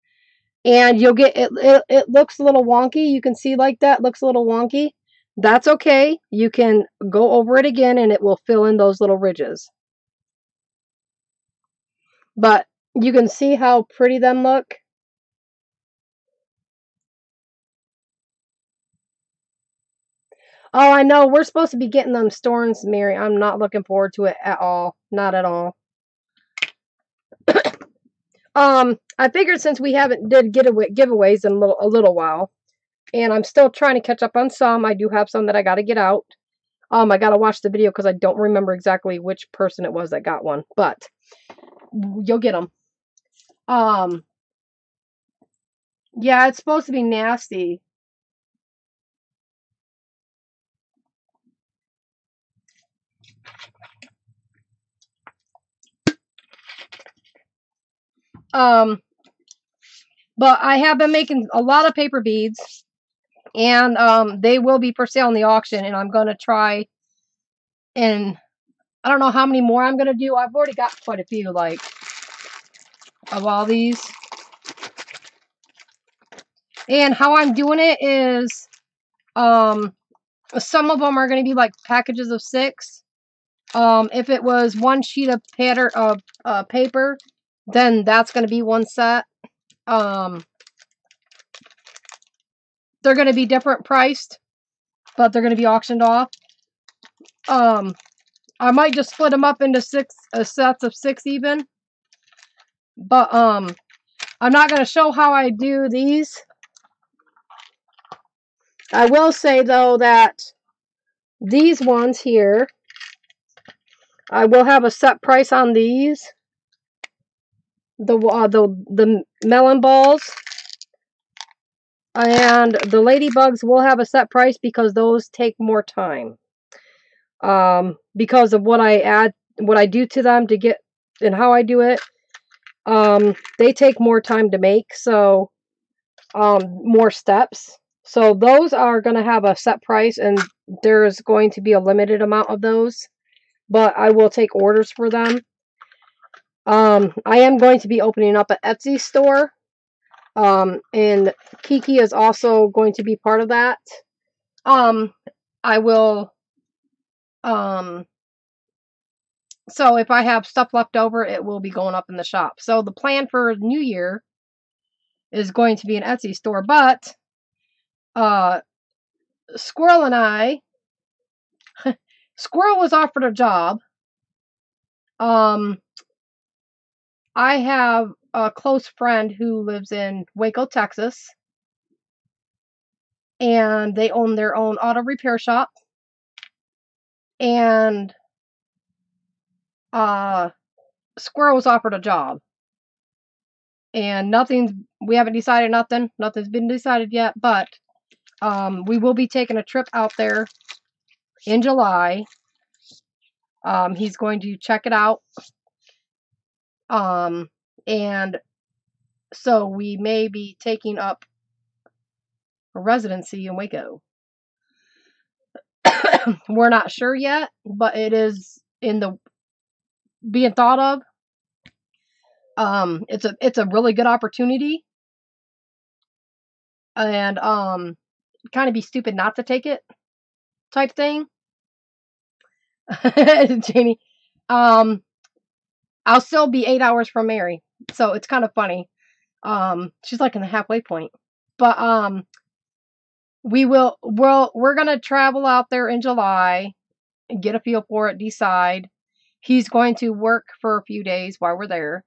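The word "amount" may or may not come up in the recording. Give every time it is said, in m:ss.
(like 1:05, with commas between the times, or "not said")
2:22.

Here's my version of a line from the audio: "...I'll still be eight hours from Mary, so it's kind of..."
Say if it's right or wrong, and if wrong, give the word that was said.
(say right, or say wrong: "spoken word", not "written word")
right.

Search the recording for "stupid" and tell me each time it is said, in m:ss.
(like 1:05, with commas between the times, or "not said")
3:48.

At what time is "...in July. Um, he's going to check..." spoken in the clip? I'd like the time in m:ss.
3:21.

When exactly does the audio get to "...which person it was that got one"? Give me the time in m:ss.
0:39.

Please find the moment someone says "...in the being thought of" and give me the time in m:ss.
3:38.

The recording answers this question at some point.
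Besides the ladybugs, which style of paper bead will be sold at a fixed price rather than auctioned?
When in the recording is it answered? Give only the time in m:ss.
1:59.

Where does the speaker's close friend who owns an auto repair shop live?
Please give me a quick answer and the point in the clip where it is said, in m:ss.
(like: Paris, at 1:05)
Waco, Texas, at 3:00.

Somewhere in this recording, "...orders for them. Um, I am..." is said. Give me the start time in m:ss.
2:24.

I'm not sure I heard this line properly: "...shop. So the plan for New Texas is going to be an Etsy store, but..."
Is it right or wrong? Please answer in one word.
wrong.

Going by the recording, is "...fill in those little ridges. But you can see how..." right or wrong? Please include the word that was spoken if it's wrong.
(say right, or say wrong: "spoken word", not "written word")
right.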